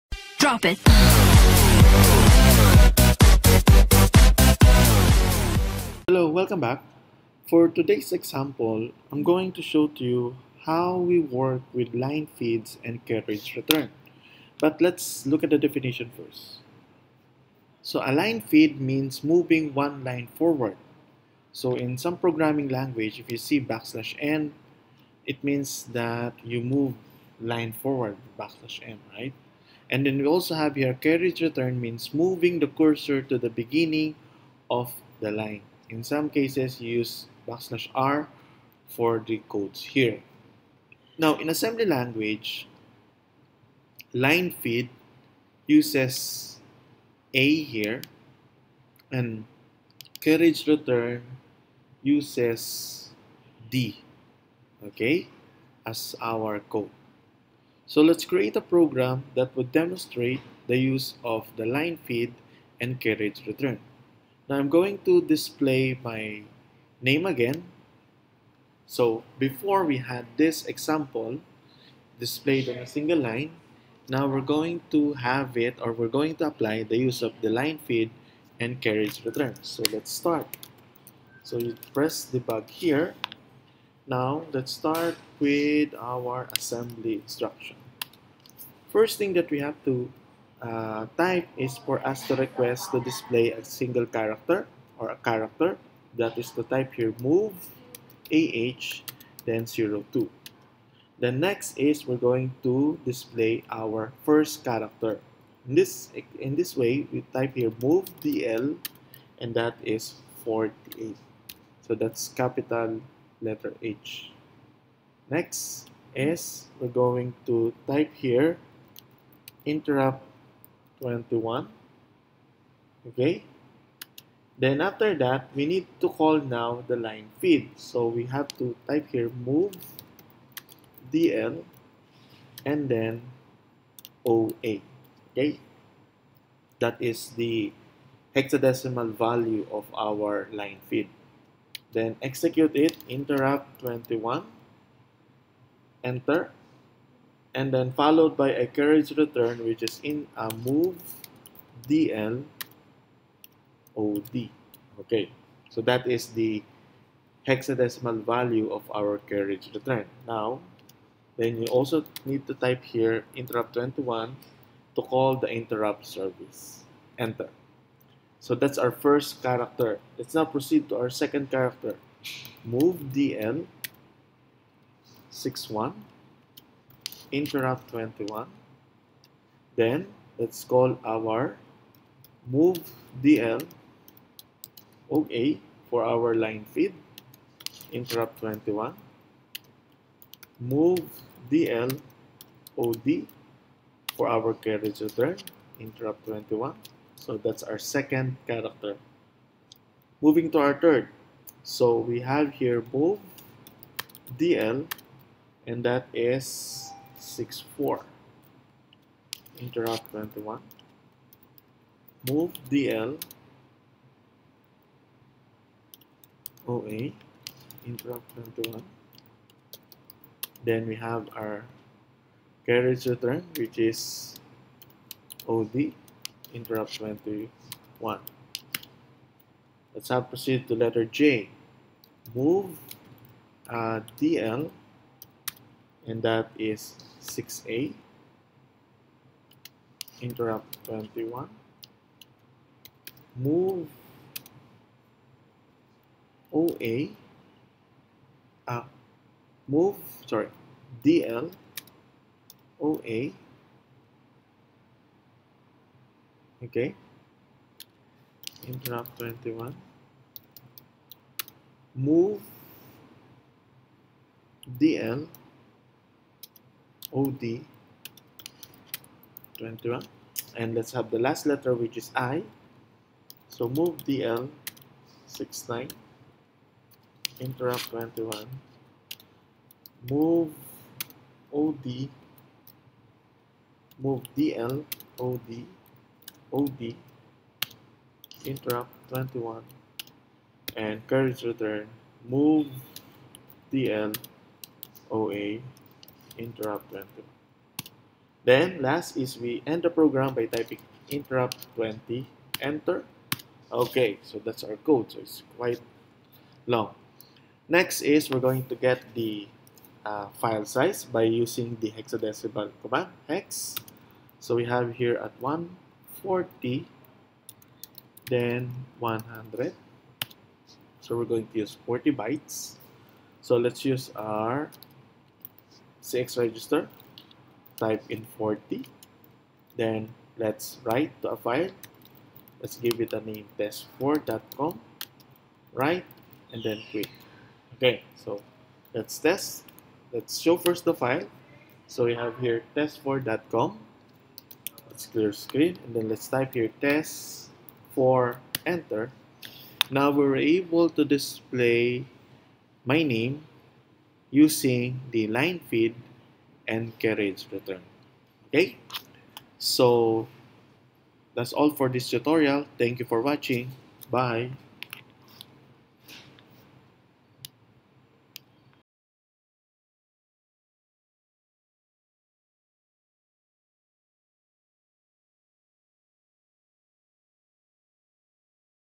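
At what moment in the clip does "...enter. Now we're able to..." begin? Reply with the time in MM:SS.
05:48.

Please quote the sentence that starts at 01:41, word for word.
The next is we're going to display our first character.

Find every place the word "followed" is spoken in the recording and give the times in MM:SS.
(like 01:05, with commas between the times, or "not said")
02:27.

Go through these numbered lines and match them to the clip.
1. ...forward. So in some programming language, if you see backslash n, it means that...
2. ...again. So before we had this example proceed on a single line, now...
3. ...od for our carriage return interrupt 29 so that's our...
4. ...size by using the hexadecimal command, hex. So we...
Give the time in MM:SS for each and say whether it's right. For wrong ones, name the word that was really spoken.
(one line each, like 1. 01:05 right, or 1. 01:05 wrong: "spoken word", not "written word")
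1. 00:20 right
2. 01:07 wrong: "displayed", not "proceed"
3. 03:12 wrong: "21", not "29"
4. 05:10 right.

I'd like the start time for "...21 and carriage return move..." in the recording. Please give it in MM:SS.
04:49.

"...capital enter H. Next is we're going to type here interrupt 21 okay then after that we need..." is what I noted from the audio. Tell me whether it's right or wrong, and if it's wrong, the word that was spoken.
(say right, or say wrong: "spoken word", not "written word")
wrong: "letter", not "enter".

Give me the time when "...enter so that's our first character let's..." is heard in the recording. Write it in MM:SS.
02:47.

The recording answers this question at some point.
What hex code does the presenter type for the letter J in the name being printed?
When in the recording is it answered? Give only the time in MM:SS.
03:57.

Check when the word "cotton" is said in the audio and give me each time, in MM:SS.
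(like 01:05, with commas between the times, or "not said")
not said.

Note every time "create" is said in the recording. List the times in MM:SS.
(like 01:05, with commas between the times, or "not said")
00:58.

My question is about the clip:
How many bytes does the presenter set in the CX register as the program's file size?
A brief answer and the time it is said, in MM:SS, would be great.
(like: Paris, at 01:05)
40, at 05:21.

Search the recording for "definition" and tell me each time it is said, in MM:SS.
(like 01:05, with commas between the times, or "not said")
00:15.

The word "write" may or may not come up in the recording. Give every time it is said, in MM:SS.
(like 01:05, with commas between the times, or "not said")
05:30, 05:35.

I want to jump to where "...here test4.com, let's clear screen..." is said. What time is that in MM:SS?
05:42.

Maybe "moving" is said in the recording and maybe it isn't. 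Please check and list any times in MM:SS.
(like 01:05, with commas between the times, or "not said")
00:19, 00:32, 03:20.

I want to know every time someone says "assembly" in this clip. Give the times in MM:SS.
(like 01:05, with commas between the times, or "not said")
00:41, 01:26.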